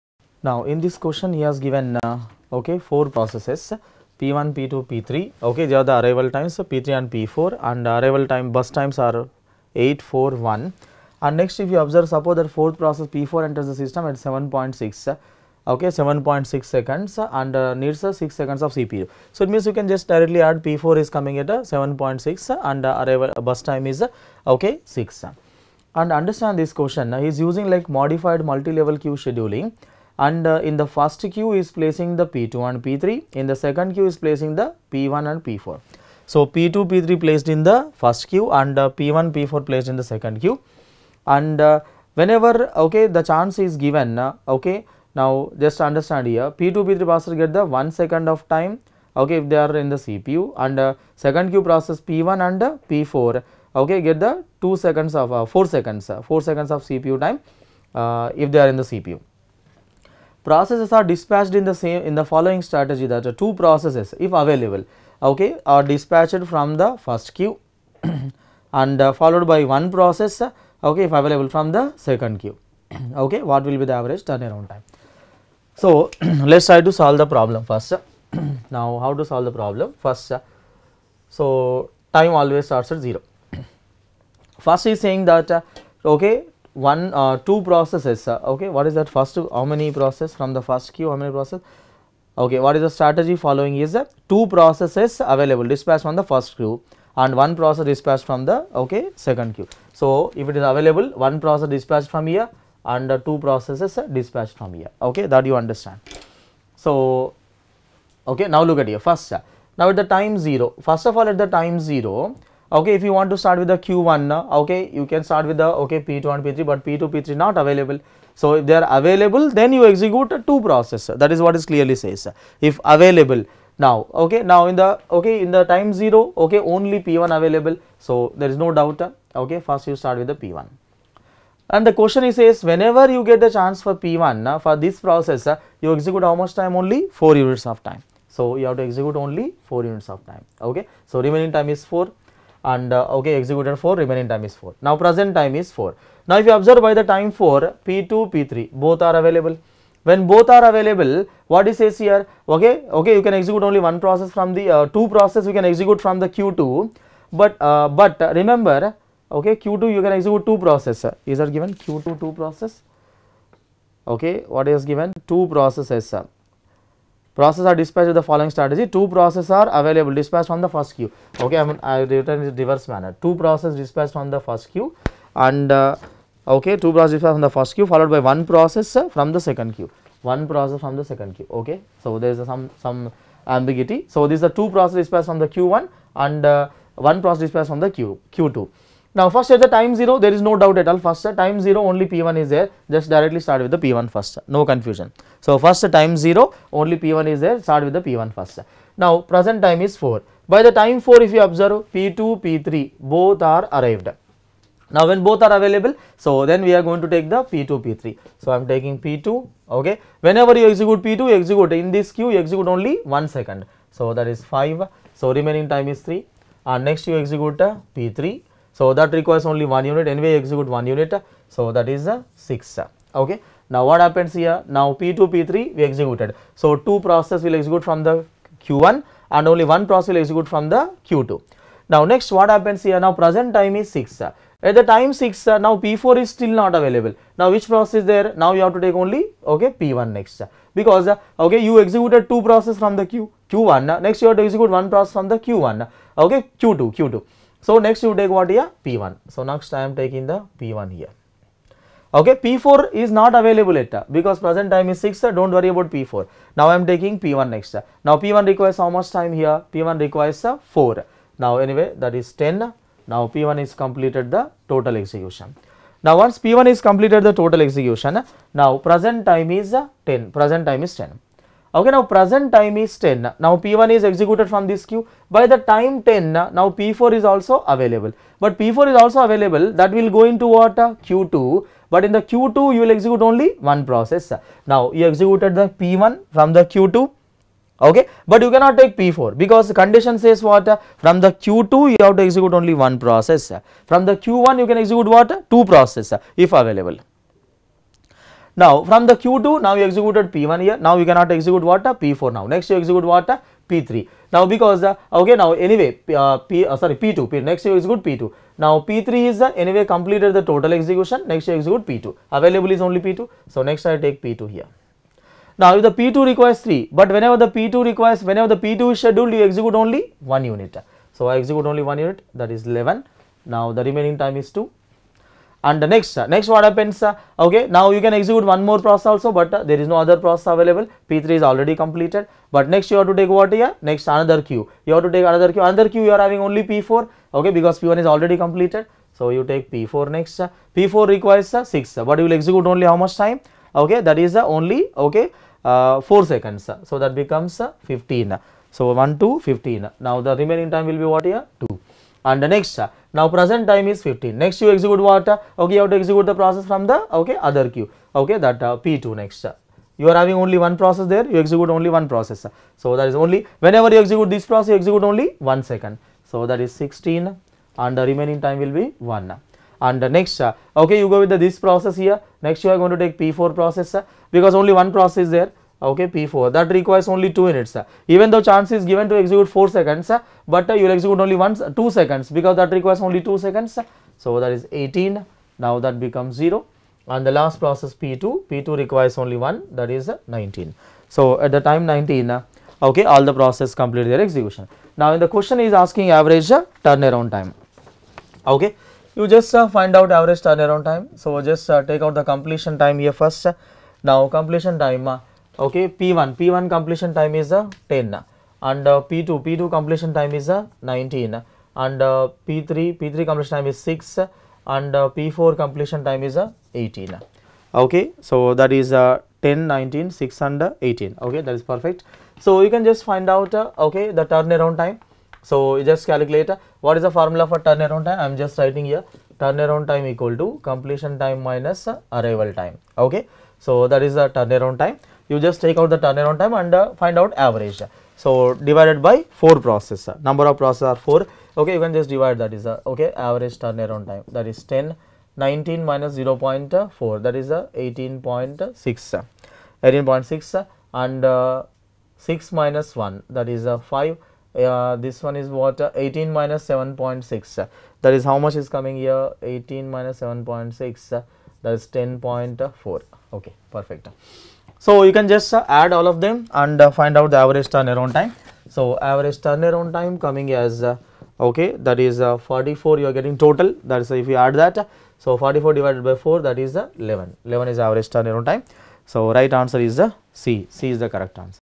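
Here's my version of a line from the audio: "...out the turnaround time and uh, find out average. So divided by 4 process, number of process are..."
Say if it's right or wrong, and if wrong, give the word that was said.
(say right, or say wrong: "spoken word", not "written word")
right.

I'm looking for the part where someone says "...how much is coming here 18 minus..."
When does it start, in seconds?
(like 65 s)
458 s.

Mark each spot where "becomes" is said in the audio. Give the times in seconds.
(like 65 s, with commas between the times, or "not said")
347 s, 385 s.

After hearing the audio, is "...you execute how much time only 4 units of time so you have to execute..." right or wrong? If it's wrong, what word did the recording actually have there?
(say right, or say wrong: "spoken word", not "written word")
right.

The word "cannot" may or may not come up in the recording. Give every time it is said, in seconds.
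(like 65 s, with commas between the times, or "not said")
288 s, 301 s.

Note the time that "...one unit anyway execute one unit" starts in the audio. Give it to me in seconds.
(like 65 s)
219 s.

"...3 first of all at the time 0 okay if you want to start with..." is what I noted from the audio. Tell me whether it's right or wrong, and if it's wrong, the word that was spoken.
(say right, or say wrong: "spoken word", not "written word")
wrong: "0", not "3".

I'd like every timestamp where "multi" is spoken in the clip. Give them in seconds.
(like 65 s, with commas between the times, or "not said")
28 s.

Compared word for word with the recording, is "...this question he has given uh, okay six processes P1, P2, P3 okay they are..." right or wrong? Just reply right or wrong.
wrong.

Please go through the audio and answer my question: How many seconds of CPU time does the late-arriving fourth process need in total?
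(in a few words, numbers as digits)
6.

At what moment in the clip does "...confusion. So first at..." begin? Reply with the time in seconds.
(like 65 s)
194 s.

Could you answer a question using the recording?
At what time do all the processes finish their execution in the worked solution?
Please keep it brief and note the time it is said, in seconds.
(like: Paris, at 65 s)
19, at 391 s.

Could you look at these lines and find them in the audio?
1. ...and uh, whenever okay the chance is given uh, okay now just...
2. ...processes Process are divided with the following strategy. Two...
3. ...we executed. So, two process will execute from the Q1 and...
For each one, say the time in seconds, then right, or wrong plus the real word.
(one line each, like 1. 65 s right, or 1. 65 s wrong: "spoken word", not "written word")
1. 41 s right
2. 165 s wrong: "dispatched", not "divided"
3. 225 s right.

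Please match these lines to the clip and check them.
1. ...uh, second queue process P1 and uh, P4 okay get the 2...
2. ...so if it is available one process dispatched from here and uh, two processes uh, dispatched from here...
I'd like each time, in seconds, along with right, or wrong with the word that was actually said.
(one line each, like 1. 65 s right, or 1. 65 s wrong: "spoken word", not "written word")
1. 50 s right
2. 99 s right.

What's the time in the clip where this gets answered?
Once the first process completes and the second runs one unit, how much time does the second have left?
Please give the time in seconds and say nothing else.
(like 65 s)
323 s.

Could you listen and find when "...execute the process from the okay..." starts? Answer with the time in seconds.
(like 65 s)
355 s.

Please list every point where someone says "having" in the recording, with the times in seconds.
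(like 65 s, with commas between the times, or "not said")
336 s, 360 s.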